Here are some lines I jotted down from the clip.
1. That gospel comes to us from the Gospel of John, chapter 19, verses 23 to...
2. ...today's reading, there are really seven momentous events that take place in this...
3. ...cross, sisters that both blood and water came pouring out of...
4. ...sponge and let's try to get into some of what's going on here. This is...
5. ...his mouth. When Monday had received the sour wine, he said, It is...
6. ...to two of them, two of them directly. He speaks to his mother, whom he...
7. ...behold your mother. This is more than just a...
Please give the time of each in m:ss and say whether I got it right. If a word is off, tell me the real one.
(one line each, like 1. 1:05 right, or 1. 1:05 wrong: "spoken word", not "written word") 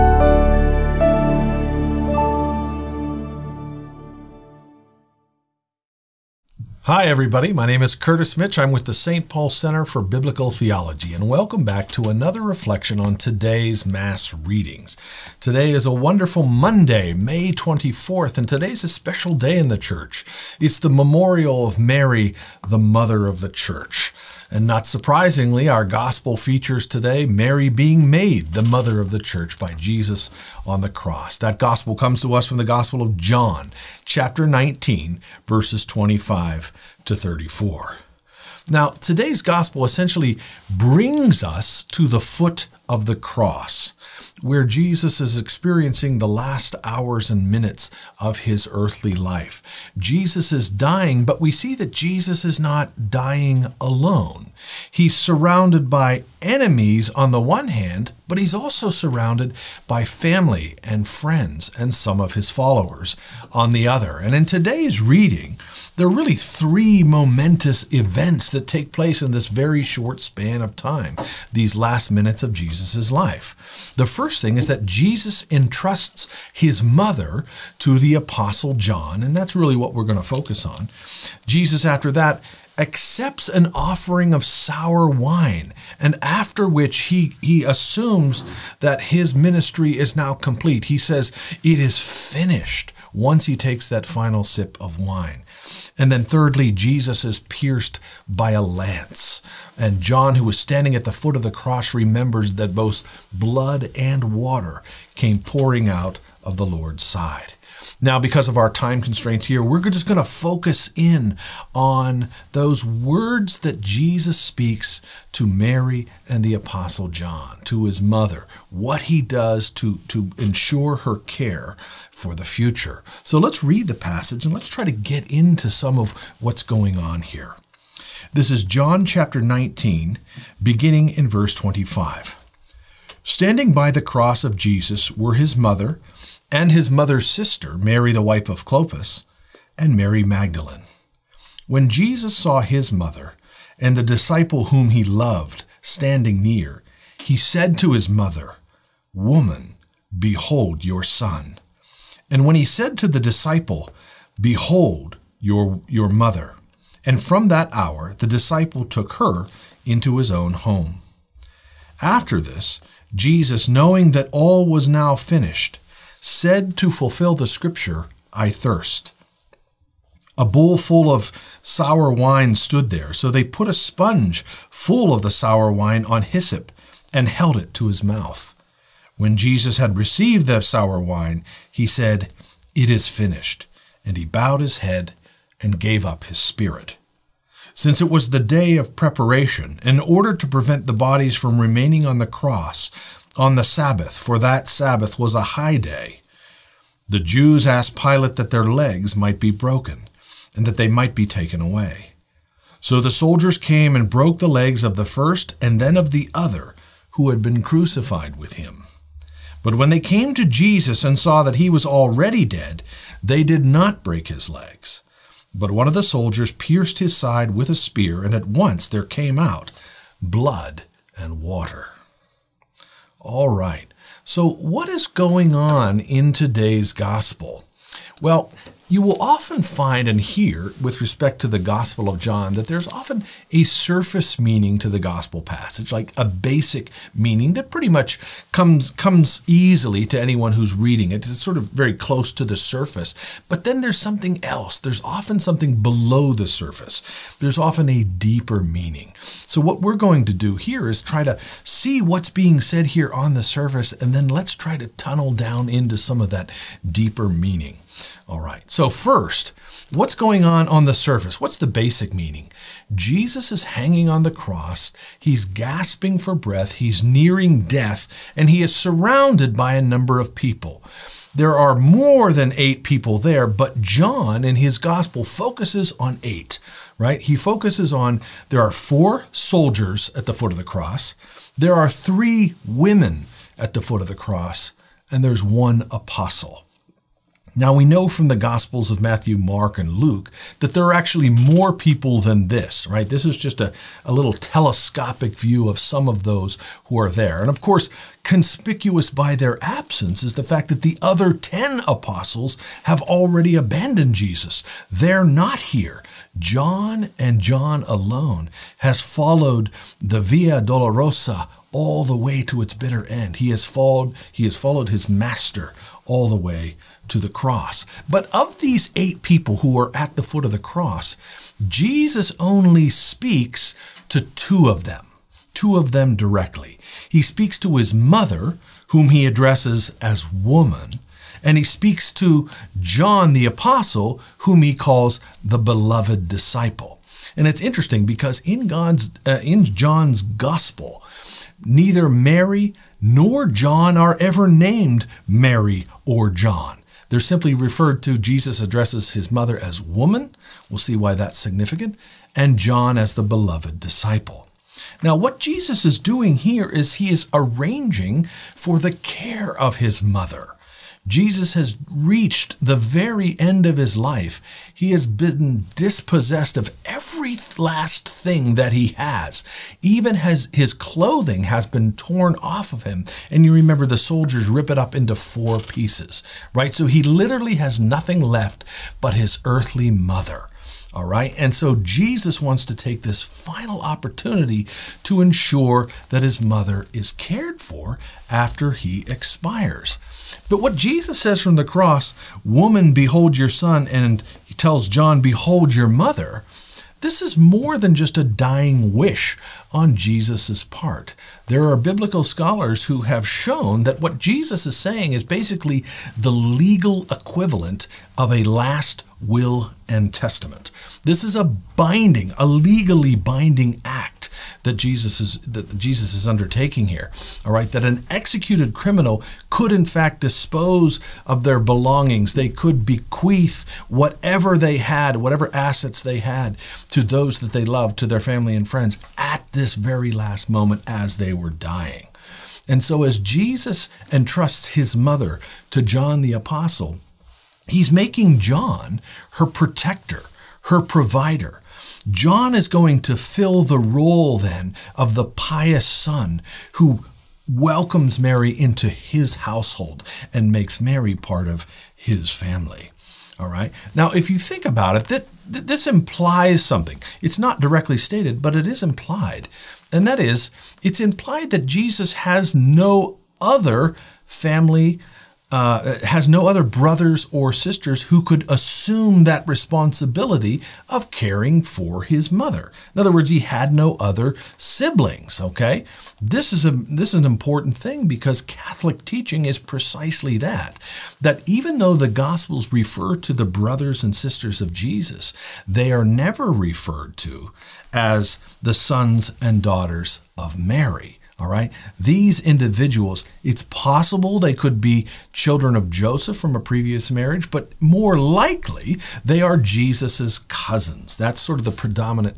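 1. 0:31 wrong: "25", not "23"
2. 1:04 wrong: "three", not "seven"
3. 1:41 wrong: "remembers", not "sisters"
4. 2:03 wrong: "passage", not "sponge"
5. 2:57 wrong: "Jesus", not "Monday"
6. 5:24 right
7. 6:35 right.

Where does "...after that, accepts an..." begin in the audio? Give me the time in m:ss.
1:21.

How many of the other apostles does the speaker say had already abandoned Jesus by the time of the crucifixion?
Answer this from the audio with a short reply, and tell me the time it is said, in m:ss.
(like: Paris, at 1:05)
10, at 5:01.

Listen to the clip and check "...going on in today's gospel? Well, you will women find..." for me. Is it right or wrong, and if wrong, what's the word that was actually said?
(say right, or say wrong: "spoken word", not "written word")
wrong: "often", not "women".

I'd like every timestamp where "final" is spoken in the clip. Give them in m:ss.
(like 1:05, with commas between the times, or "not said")
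1:34, 6:23.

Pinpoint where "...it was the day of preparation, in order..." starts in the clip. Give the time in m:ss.
3:08.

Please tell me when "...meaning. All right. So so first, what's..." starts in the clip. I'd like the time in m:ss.
4:17.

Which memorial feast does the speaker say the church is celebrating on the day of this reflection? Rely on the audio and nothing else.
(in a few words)
Mary, the Mother of the Church.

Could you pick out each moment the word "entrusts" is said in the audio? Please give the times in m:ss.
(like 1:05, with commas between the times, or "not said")
1:15, 7:14.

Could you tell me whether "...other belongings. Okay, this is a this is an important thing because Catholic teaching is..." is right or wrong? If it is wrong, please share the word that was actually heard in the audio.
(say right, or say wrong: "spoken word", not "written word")
wrong: "siblings", not "belongings".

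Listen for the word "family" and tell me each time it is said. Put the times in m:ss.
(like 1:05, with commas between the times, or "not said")
1:00, 7:08, 7:32, 7:44.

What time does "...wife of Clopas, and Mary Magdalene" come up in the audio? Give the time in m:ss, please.
2:18.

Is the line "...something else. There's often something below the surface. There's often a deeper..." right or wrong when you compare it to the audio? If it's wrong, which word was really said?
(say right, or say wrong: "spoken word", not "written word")
right.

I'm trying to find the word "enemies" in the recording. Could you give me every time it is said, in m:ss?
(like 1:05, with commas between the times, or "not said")
0:56.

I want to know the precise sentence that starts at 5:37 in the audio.
And it's interesting because in God's uh, in John's gospel, neither Mary nor John are ever named Mary or John.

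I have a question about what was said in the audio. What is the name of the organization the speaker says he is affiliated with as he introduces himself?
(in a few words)
St. Paul Center for Biblical Theology.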